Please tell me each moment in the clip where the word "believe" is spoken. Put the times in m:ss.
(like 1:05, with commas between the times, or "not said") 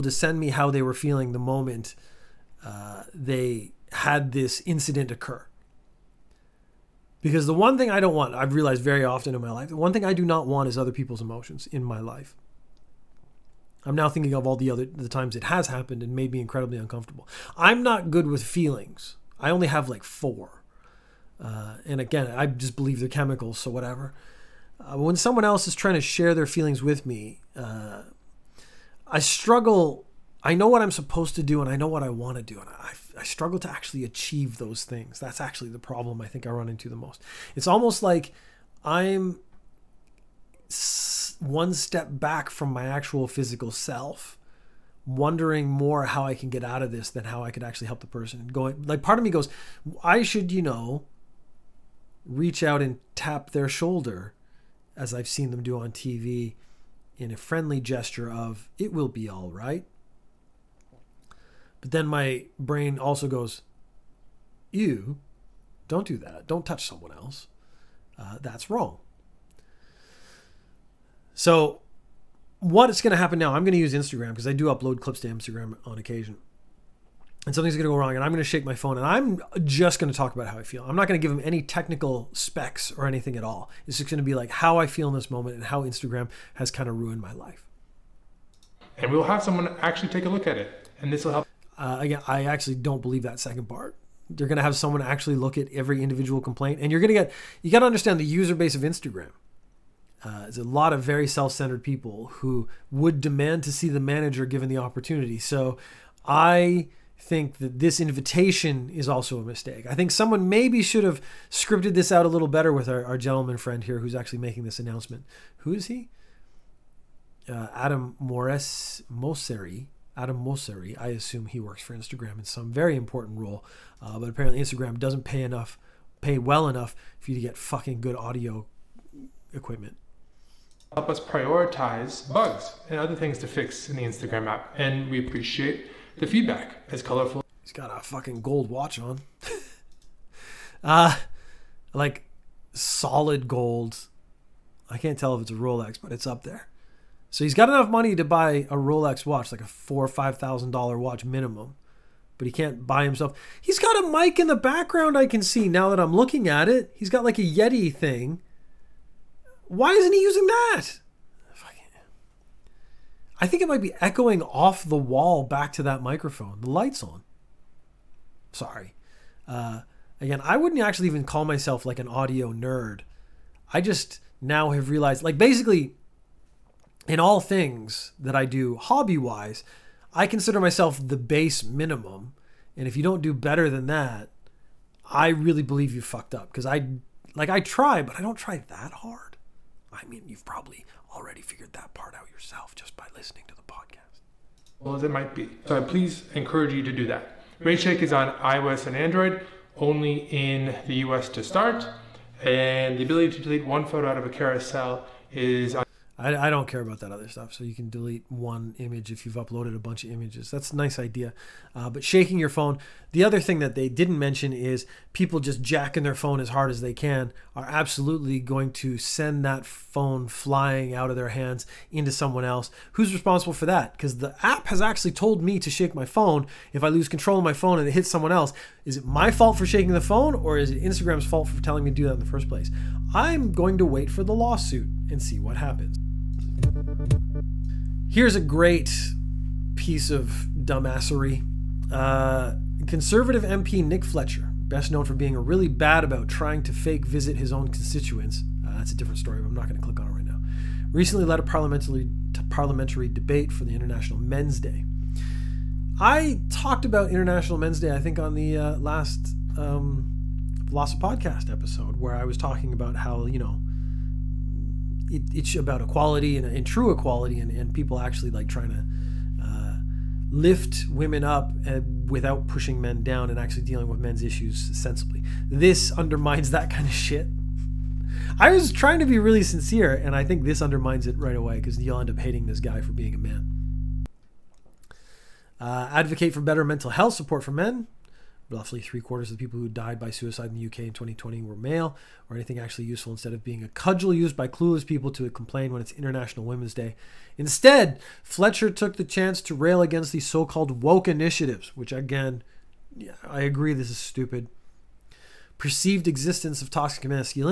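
0:22, 1:33, 3:05.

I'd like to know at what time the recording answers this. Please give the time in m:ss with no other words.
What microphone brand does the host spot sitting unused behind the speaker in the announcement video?
2:37.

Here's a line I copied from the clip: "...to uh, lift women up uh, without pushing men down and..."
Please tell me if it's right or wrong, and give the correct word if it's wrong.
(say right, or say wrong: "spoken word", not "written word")
right.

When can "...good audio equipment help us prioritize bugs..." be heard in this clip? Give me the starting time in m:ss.
2:07.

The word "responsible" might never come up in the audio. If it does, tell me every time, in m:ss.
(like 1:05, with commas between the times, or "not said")
3:43.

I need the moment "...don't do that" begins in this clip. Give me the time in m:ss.
1:05.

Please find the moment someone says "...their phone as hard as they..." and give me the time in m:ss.
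3:36.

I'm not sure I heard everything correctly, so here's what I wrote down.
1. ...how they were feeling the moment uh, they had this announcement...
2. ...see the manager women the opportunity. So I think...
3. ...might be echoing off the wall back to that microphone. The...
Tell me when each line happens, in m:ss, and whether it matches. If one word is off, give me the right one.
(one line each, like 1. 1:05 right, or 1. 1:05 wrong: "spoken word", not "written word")
1. 0:00 wrong: "incident", not "announcement"
2. 1:43 wrong: "given", not "women"
3. 2:43 right.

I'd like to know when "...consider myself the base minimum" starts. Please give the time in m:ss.
3:00.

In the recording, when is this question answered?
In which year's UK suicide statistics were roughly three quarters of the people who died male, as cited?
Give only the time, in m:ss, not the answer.
4:50.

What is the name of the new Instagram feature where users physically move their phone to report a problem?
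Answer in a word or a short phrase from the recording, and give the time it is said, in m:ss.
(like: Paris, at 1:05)
RageShake, at 3:17.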